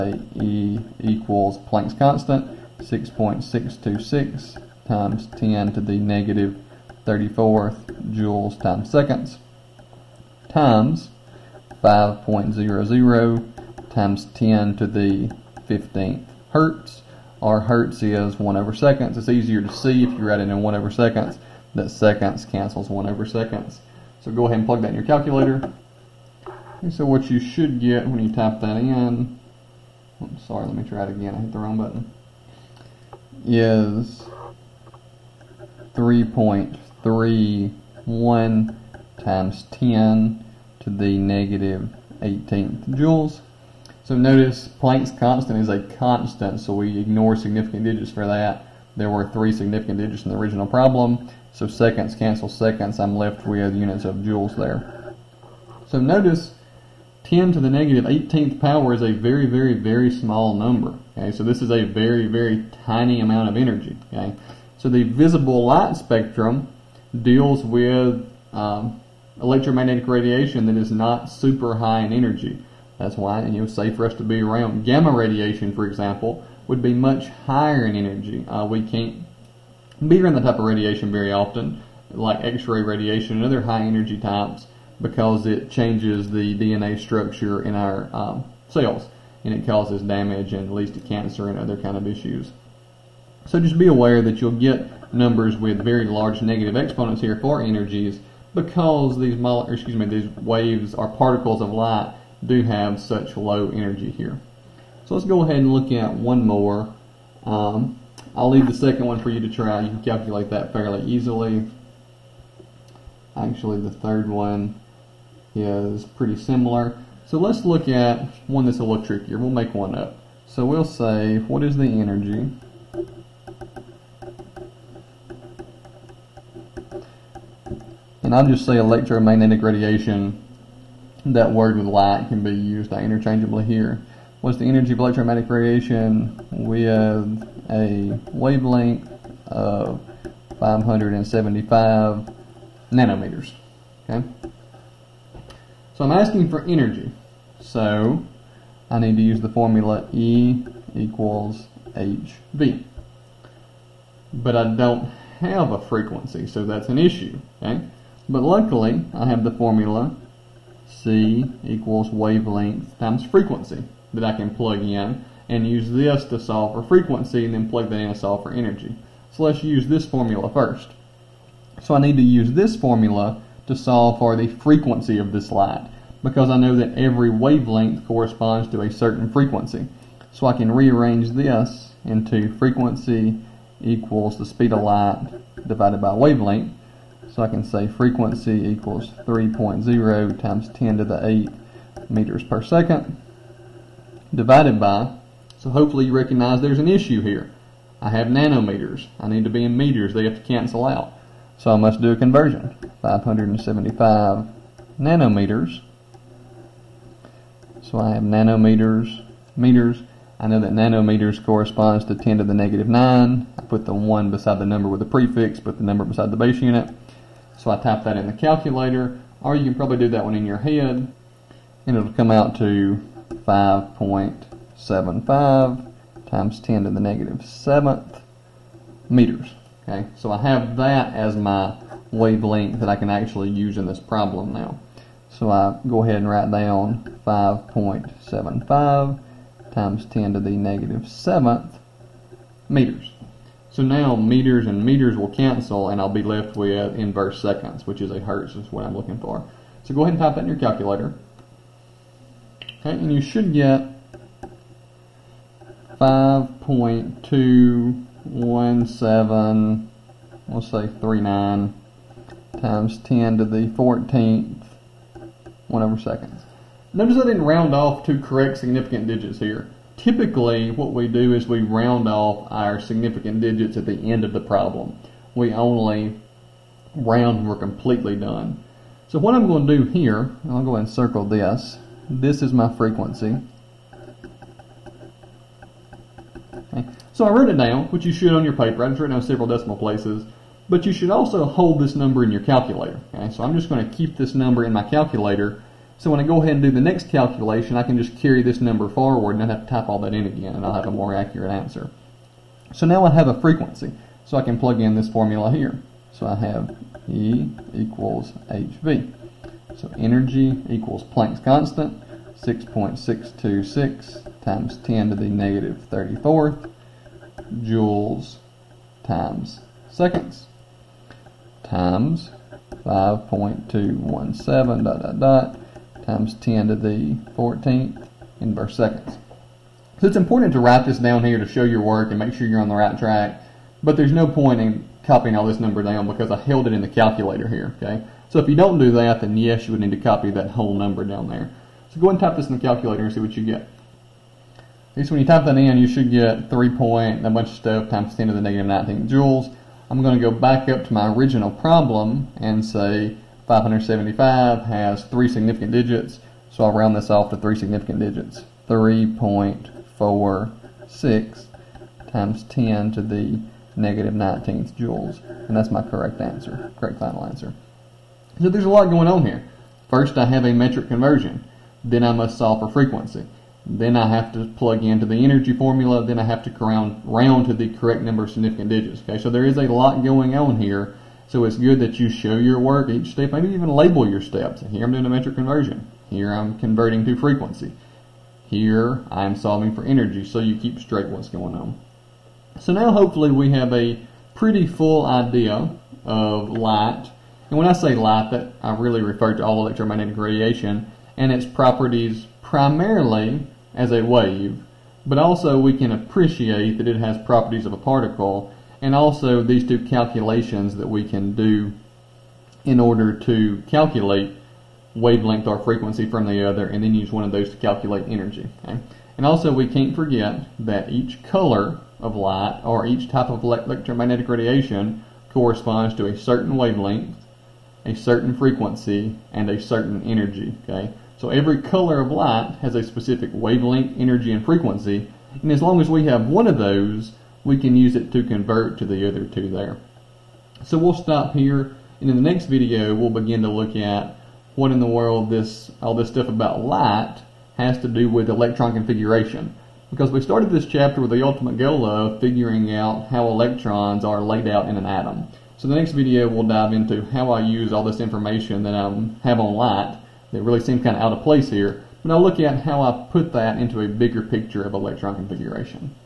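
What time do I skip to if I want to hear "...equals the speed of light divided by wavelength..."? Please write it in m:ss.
3:03.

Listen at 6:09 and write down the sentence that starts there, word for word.
First, I have a metric conversion.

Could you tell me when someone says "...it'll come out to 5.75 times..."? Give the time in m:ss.
3:41.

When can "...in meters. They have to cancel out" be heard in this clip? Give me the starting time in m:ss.
3:19.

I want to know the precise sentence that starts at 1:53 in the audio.
Actually, the third one is pretty similar.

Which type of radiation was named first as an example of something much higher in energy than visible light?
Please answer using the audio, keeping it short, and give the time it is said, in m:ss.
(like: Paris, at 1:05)
Gamma radiation, at 1:14.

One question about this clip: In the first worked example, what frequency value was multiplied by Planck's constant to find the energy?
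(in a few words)
5.00 x 10^15 hertz.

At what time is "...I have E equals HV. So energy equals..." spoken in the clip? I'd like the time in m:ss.
5:06.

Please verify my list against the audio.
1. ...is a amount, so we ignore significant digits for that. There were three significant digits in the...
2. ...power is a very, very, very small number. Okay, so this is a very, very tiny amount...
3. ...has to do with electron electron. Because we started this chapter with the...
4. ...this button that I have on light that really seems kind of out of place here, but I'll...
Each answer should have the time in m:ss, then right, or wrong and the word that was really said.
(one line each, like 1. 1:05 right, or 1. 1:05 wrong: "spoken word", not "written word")
1. 0:45 wrong: "constant", not "amount"
2. 0:58 right
3. 7:27 wrong: "configuration", not "electron"
4. 7:37 wrong: "information", not "button".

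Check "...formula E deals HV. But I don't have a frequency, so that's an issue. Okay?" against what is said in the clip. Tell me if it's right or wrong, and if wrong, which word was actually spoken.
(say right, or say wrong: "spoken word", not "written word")
wrong: "equals", not "deals".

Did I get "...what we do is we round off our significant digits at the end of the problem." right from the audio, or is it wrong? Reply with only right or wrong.
right.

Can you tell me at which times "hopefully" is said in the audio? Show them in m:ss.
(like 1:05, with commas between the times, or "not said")
3:15, 6:32.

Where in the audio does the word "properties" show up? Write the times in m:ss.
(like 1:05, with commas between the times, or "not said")
6:41, 6:47.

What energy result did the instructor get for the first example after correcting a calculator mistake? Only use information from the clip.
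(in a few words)
3.31 x 10^-18 joules.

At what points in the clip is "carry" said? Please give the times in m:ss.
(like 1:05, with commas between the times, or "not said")
4:58.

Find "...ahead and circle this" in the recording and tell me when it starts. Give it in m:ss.
4:40.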